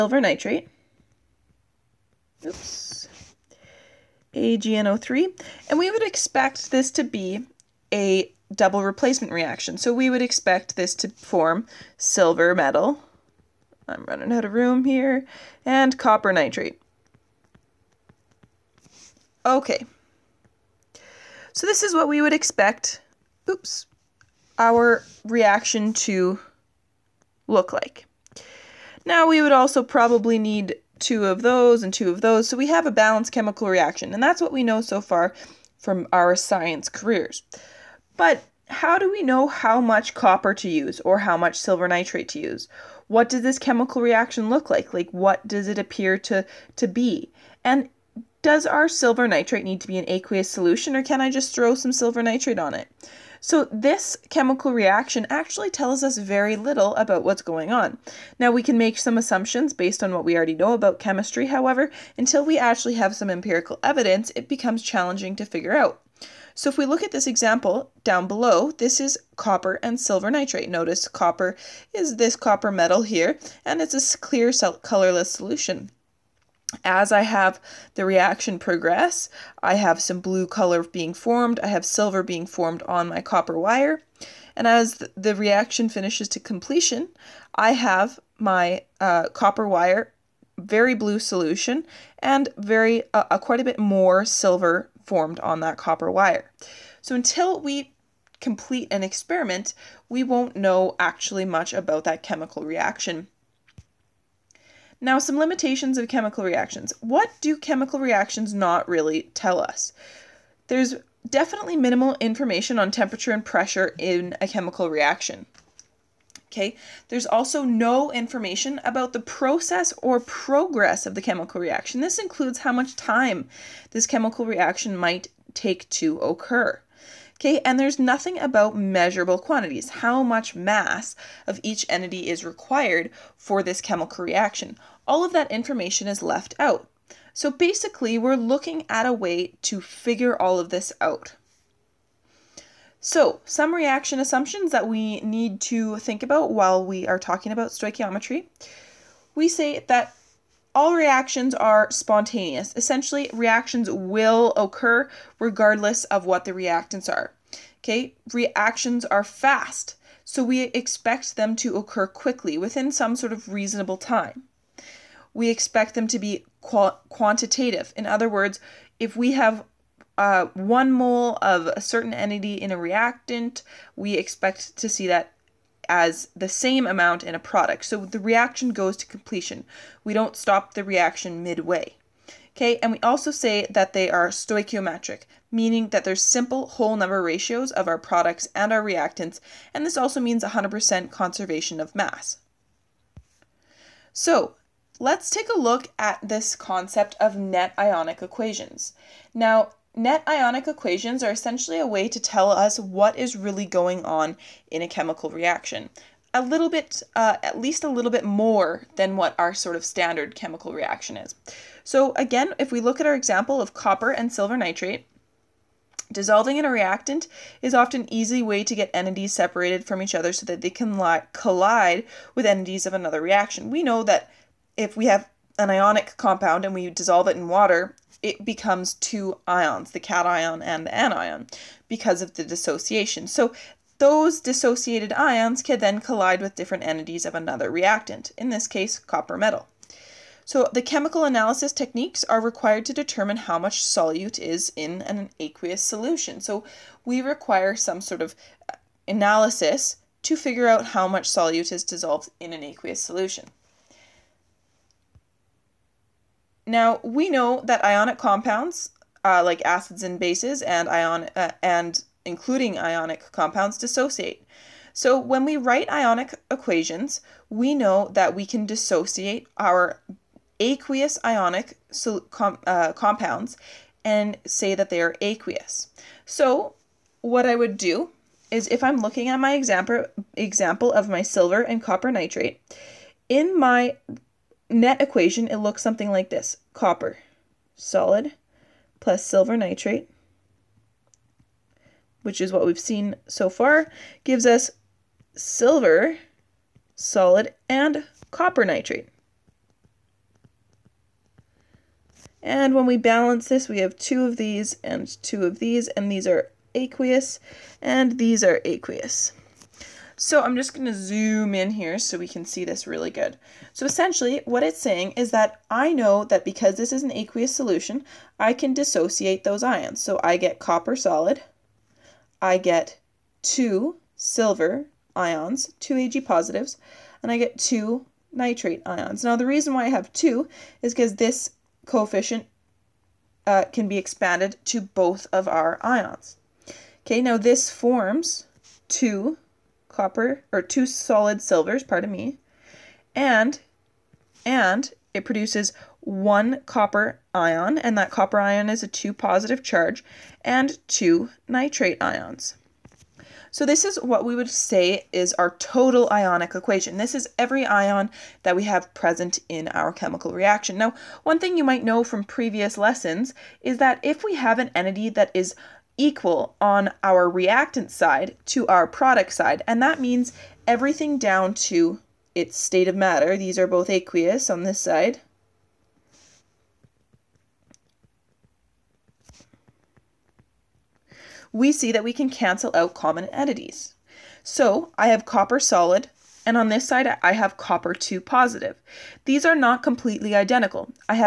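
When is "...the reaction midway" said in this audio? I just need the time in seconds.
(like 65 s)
180 s.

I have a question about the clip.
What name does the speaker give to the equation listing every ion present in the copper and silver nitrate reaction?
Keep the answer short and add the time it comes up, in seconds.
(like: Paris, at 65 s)
total ionic equation, at 355 s.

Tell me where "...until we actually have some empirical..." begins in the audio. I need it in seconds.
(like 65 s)
62 s.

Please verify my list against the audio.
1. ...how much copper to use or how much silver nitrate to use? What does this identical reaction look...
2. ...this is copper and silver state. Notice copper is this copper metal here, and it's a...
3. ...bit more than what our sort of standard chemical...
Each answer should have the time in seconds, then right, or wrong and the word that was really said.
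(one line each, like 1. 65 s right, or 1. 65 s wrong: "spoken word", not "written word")
1. 39 s wrong: "chemical", not "identical"
2. 68 s wrong: "nitrate", not "state"
3. 208 s right.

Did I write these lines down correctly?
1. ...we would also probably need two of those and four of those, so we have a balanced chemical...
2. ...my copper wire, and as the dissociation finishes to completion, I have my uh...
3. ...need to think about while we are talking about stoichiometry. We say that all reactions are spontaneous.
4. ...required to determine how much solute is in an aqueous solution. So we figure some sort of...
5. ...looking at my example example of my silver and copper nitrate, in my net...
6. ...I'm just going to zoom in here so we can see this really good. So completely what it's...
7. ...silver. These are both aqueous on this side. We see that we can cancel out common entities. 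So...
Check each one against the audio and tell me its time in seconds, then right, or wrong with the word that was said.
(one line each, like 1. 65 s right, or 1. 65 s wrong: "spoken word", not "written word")
1. 29 s wrong: "two", not "four"
2. 83 s wrong: "reaction", not "dissociation"
3. 145 s right
4. 242 s wrong: "require", not "figure"
5. 278 s right
6. 310 s wrong: "essentially", not "completely"
7. 372 s wrong: "matter", not "silver".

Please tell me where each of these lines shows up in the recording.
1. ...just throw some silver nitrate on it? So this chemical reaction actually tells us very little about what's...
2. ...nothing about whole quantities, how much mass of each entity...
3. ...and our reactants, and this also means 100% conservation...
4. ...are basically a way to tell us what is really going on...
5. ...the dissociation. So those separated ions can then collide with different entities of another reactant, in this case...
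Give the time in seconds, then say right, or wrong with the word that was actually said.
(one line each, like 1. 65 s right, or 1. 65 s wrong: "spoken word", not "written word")
1. 51 s right
2. 127 s wrong: "measurable", not "whole"
3. 188 s right
4. 201 s wrong: "essentially", not "basically"
5. 232 s wrong: "dissociated", not "separated".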